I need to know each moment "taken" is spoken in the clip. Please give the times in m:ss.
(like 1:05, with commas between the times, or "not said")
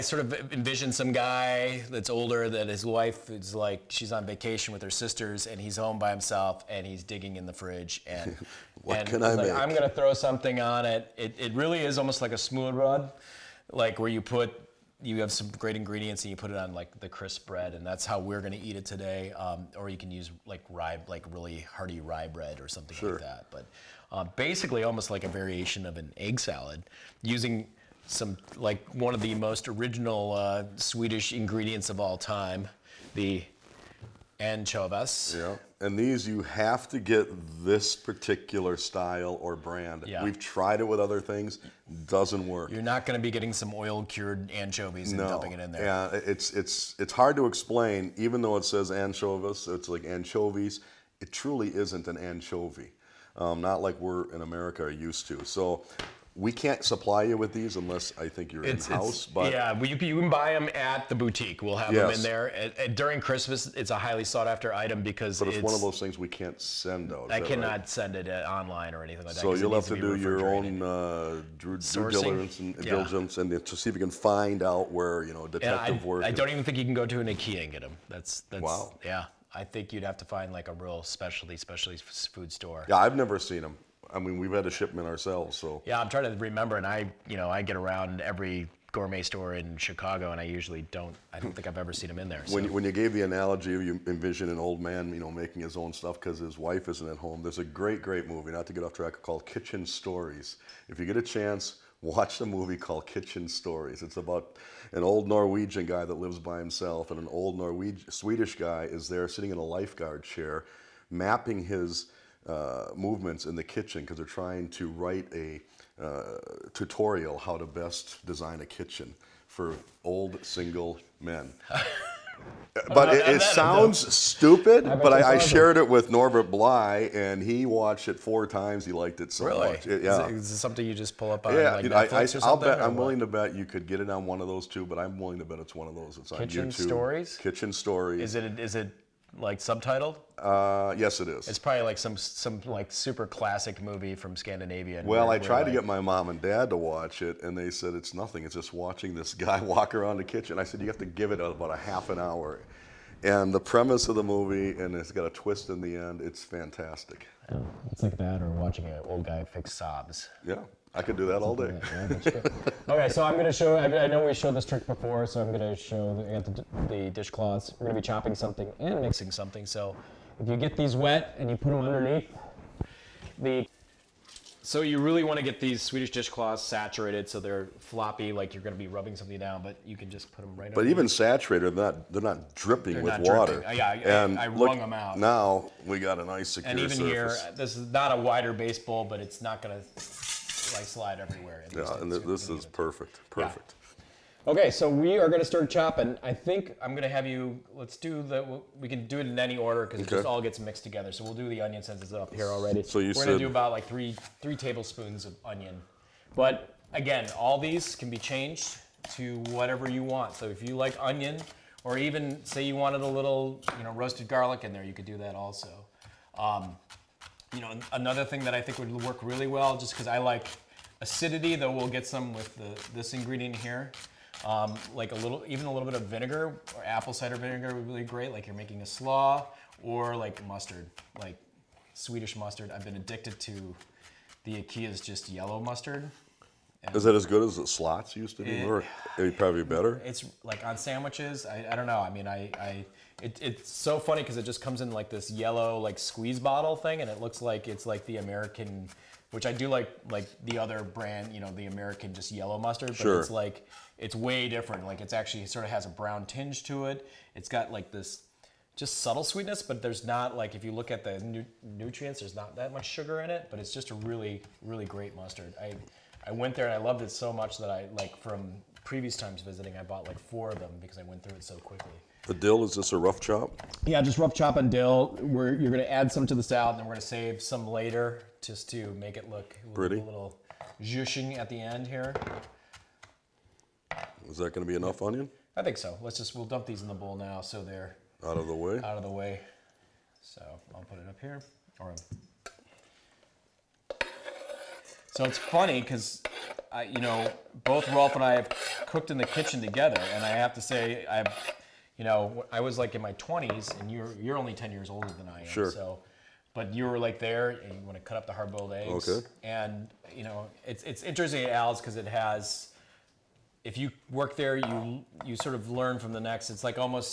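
not said.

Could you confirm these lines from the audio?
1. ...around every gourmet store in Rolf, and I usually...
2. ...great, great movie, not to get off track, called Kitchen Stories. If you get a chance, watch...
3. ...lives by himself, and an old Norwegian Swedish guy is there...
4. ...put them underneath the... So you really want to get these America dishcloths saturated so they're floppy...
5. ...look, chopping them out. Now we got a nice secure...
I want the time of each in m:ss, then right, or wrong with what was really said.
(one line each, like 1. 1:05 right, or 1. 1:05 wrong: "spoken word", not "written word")
1. 1:27 wrong: "Chicago", not "Rolf"
2. 1:37 right
3. 1:46 right
4. 2:51 wrong: "Swedish", not "America"
5. 3:04 wrong: "wrung", not "chopping".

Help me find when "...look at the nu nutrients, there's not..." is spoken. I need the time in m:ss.
4:20.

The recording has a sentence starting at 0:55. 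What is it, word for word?
So we can't supply you with these unless I think you're in house.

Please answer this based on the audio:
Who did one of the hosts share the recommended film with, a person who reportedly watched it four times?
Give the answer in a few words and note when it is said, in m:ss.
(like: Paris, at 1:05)
Norbert Bly, at 2:06.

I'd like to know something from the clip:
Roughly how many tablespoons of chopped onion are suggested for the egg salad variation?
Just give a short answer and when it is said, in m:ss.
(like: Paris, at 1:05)
3, at 3:24.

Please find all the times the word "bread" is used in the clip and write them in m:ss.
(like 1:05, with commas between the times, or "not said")
0:17, 0:22.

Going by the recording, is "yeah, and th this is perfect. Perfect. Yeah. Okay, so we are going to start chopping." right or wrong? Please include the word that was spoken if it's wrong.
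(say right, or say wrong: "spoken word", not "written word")
right.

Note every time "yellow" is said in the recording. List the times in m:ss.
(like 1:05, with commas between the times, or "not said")
3:55, 4:05, 4:12.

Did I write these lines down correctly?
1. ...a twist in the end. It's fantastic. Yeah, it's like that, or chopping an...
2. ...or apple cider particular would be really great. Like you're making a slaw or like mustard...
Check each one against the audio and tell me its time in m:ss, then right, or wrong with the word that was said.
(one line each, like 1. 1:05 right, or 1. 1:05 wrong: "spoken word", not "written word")
1. 2:35 wrong: "watching", not "chopping"
2. 3:46 wrong: "vinegar", not "particular".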